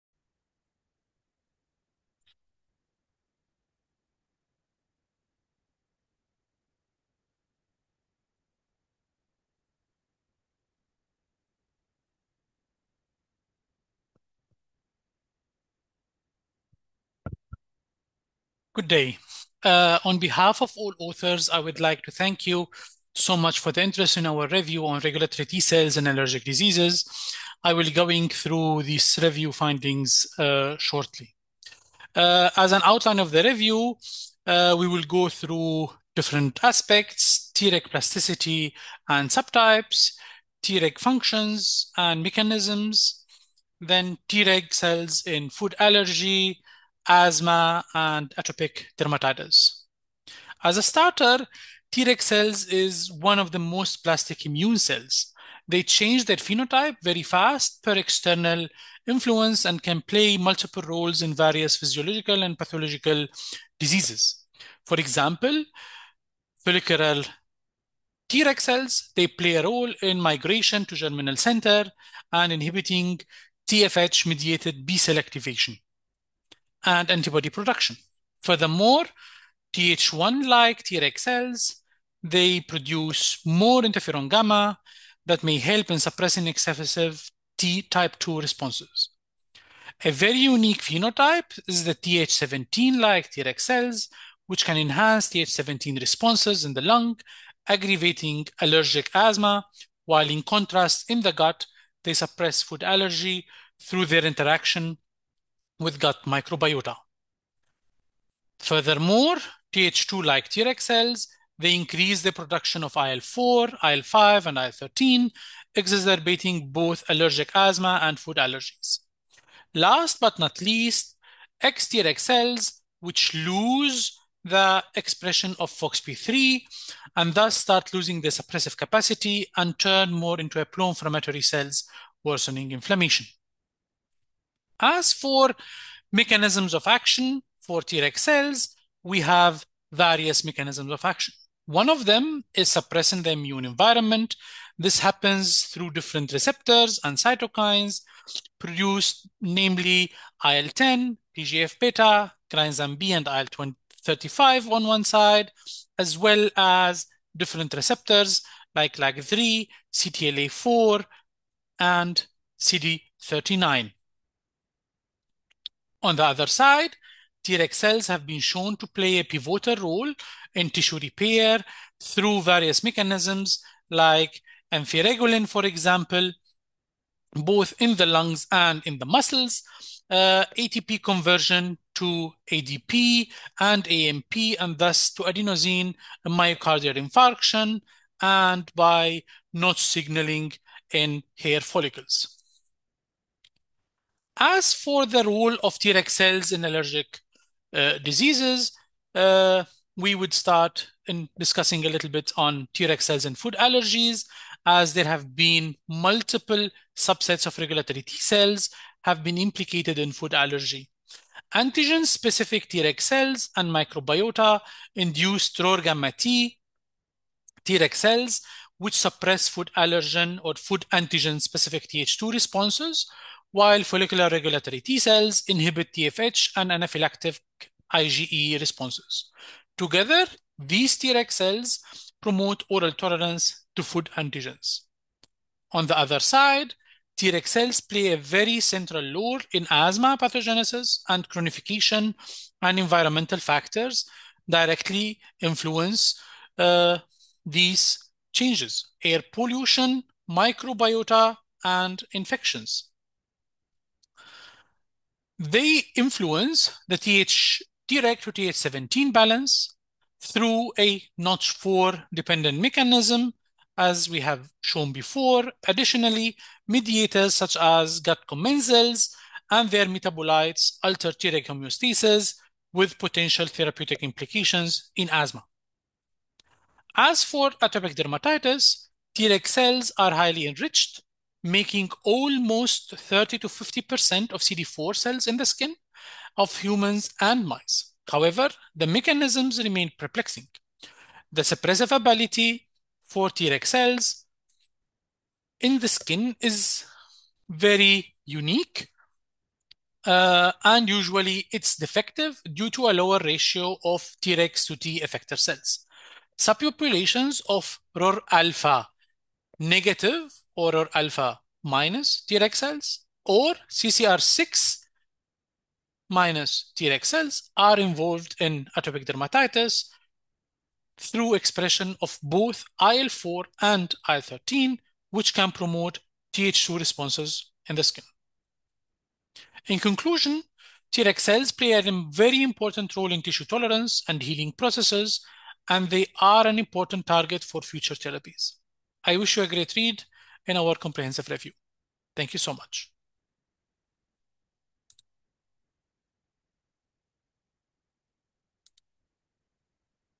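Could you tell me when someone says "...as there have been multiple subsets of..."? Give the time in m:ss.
3:24.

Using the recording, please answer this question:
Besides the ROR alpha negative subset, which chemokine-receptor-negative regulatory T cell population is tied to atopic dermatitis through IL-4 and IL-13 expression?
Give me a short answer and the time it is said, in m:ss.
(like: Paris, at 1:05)
CCR6 minus Treg cells, at 5:13.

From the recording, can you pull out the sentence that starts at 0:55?
They change their phenotype very fast per external influence and can play multiple roles in various physiological and pathological diseases.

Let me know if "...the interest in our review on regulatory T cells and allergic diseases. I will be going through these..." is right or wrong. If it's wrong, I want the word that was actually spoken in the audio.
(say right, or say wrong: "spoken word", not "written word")
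right.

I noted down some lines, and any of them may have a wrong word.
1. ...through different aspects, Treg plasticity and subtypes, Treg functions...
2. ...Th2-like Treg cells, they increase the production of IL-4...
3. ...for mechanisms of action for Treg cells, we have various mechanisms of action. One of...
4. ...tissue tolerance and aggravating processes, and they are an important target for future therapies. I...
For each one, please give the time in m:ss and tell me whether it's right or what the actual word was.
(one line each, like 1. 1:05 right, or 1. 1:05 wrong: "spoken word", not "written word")
1. 0:35 right
2. 1:49 right
3. 2:15 right
4. 5:33 wrong: "healing", not "aggravating".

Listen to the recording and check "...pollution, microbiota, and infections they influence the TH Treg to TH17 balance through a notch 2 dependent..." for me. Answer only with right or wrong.
wrong.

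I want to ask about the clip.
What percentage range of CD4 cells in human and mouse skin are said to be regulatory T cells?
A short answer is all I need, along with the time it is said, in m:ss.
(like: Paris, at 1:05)
30 to 50%, at 4:42.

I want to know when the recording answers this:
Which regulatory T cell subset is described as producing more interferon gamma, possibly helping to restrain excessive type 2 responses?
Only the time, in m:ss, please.
1:19.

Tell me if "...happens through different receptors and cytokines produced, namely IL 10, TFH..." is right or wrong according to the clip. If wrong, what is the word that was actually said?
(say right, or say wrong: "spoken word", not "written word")
wrong: "TGF", not "TFH".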